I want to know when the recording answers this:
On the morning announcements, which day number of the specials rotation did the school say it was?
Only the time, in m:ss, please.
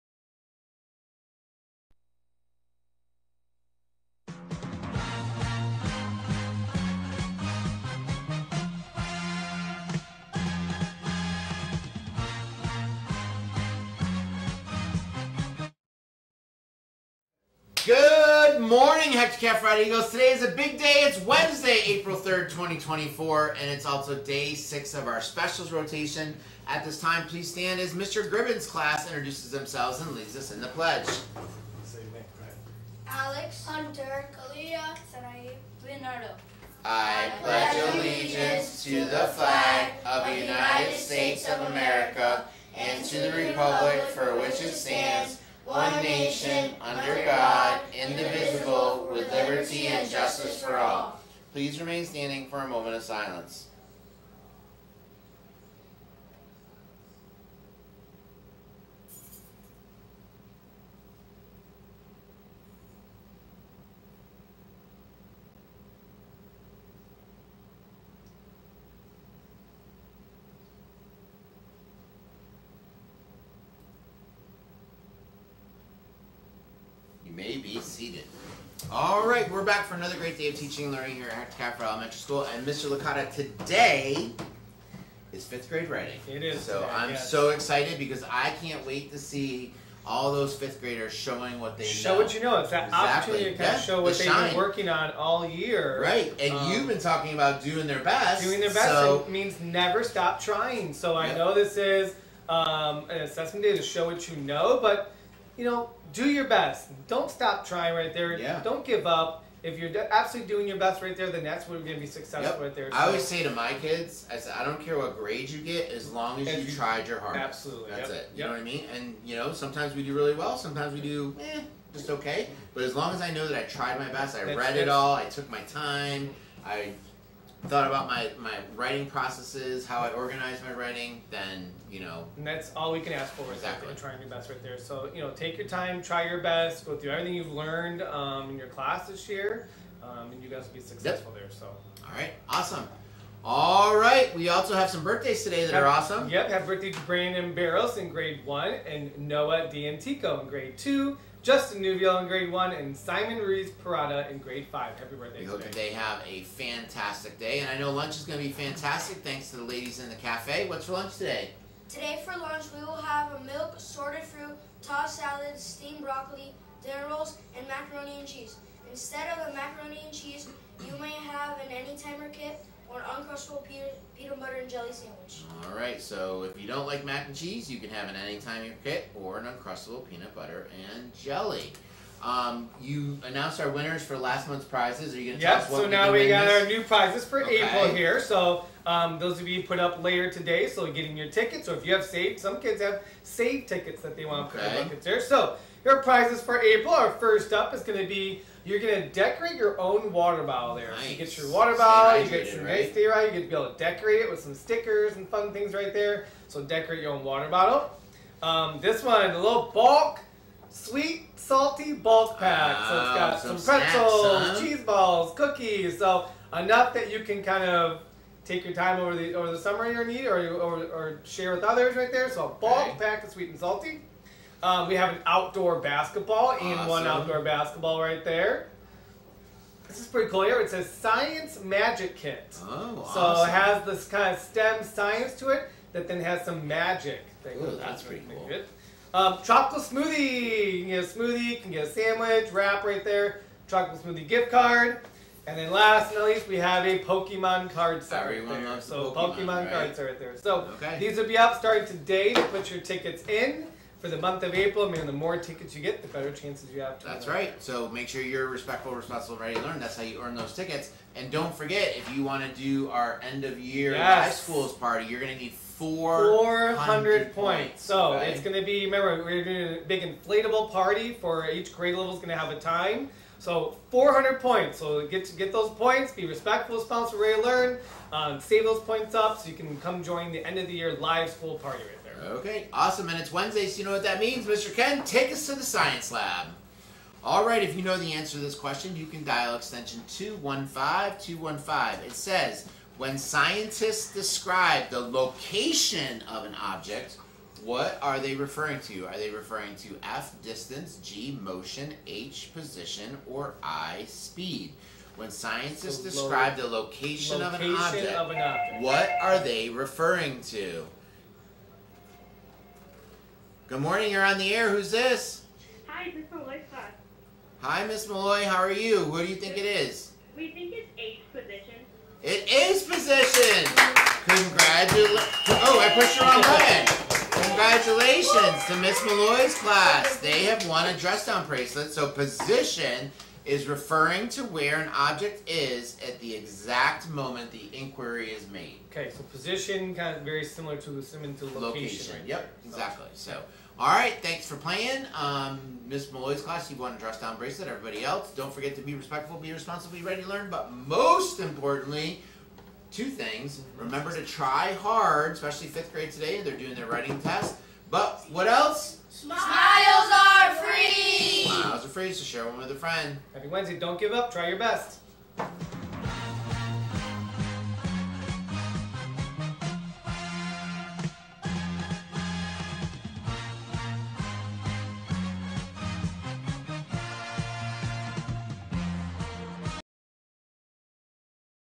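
0:24.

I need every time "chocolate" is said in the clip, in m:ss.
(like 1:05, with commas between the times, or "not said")
3:59, 4:03.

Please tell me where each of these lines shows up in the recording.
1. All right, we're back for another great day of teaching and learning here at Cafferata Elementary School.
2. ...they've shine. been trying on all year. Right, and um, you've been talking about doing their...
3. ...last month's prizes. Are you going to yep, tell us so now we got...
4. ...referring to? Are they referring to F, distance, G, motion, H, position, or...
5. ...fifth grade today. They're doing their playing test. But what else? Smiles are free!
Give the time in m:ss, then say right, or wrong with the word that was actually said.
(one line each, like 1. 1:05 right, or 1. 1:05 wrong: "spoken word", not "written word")
1. 1:18 right
2. 1:34 wrong: "working", not "trying"
3. 3:04 right
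4. 4:58 right
5. 5:55 wrong: "writing", not "playing".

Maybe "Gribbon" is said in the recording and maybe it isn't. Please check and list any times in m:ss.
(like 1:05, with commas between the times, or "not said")
0:28.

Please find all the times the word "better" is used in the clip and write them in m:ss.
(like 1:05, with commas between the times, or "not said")
4:16.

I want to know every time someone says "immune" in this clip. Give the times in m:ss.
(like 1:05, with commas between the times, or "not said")
not said.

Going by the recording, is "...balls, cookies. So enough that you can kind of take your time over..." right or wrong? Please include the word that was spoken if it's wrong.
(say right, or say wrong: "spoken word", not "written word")
right.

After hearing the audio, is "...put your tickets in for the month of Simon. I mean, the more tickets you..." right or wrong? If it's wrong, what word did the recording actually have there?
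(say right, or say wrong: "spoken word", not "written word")
wrong: "April", not "Simon".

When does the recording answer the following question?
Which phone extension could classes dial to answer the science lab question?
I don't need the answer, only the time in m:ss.
4:49.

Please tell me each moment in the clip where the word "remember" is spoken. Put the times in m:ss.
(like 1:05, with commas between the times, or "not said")
4:28, 5:53.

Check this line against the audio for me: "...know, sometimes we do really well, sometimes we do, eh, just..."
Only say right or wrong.
right.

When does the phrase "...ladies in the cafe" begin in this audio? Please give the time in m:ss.
2:39.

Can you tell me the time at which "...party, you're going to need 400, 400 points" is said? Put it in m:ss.
4:24.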